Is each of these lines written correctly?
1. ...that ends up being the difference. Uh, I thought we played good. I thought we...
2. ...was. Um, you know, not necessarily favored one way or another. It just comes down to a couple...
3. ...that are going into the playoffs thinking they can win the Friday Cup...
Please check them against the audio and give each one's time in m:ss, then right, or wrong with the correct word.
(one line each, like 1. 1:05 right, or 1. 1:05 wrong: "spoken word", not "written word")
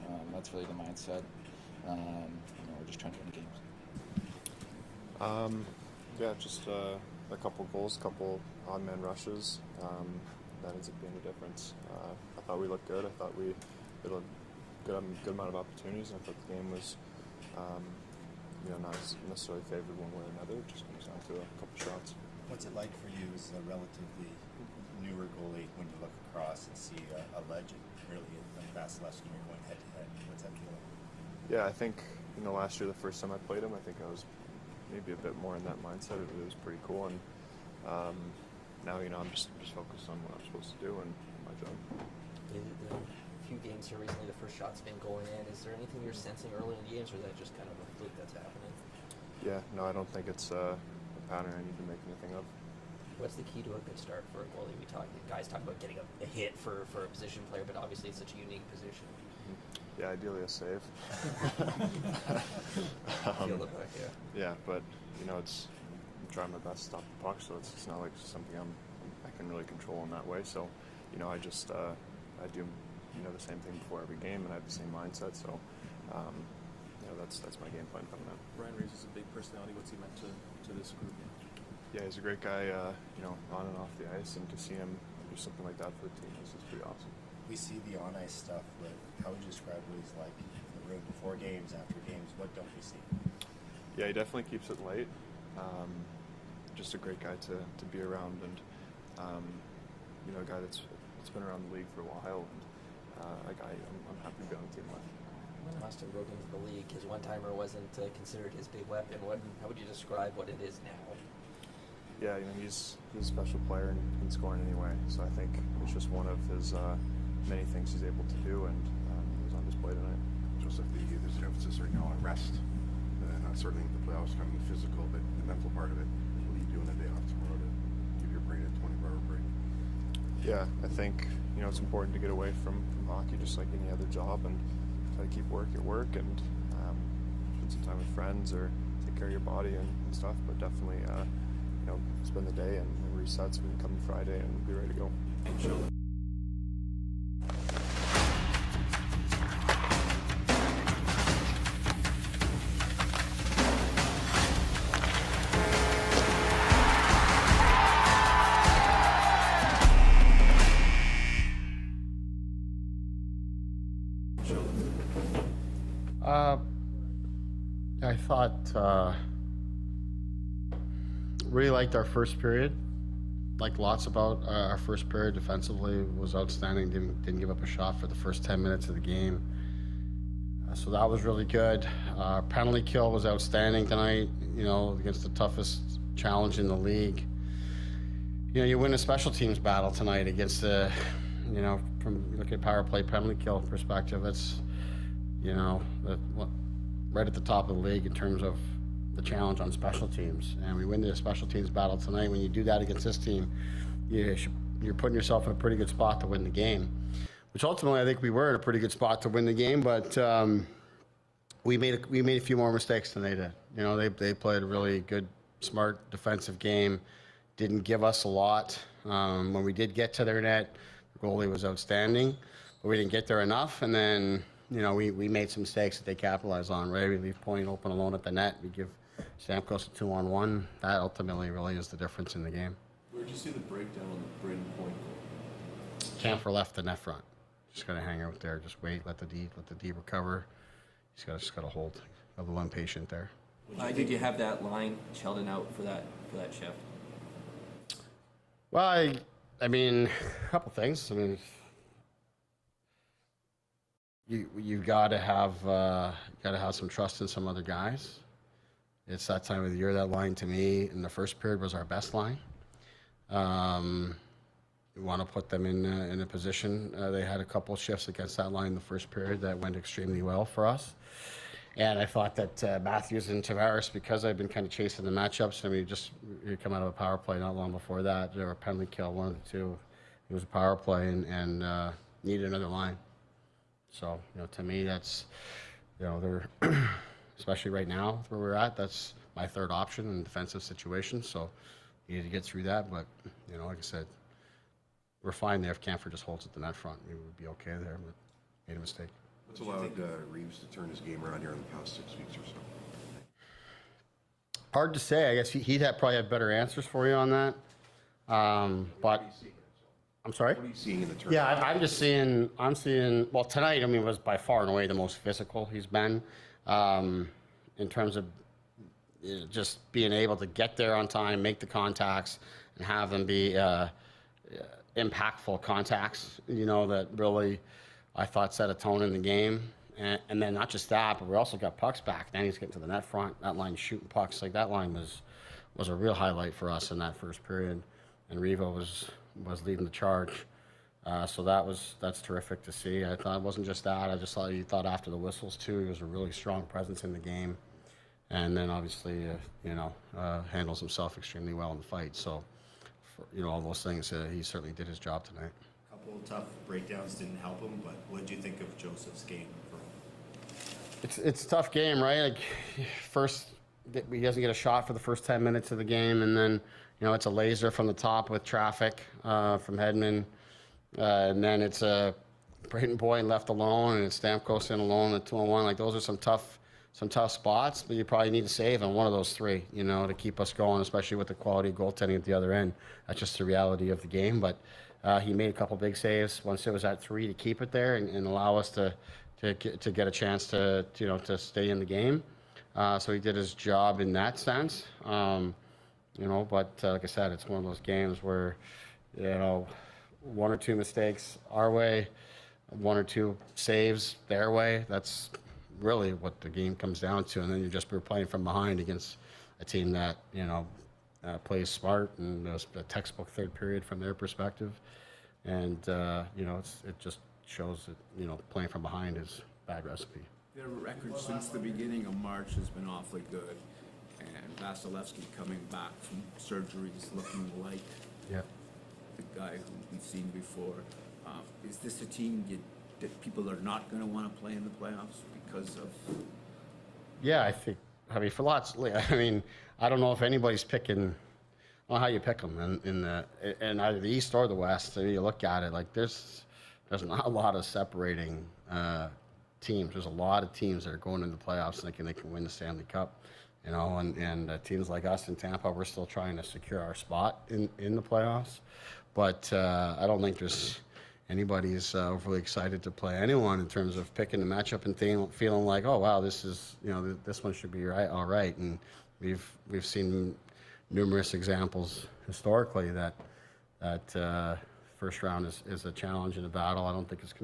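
1. 0:10 wrong: "looked", not "played"
2. 0:16 right
3. 7:30 wrong: "Stanley", not "Friday".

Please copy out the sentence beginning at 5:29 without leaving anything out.
And, and then not just that, but we also got pucks back.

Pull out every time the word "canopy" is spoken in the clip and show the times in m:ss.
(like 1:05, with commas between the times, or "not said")
not said.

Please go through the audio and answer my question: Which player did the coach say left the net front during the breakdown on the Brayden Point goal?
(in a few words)
Camphor.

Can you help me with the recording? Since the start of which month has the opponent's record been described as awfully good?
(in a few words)
March.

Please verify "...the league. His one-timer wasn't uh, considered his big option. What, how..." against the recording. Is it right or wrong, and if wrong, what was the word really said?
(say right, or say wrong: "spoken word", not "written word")
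wrong: "weapon", not "option".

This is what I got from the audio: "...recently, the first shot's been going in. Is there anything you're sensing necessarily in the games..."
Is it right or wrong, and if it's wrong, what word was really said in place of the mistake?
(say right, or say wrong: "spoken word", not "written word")
wrong: "early", not "necessarily".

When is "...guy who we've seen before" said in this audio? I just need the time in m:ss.
7:09.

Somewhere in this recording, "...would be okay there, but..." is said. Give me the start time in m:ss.
4:57.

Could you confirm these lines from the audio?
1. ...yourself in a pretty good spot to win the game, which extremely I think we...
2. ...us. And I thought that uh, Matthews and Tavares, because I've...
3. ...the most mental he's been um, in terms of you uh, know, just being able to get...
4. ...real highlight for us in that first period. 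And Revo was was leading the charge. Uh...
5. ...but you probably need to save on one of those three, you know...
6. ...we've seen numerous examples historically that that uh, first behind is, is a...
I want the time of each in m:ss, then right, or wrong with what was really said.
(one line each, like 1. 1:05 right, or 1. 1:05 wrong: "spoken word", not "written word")
1. 3:25 wrong: "ultimately", not "extremely"
2. 4:30 right
3. 5:14 wrong: "physical", not "mental"
4. 5:35 right
5. 6:17 right
6. 7:49 wrong: "round", not "behind".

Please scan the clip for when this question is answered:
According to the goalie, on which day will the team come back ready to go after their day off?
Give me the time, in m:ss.
2:24.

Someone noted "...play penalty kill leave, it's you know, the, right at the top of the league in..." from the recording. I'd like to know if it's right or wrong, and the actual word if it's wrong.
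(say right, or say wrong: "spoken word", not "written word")
wrong: "perspective", not "leave".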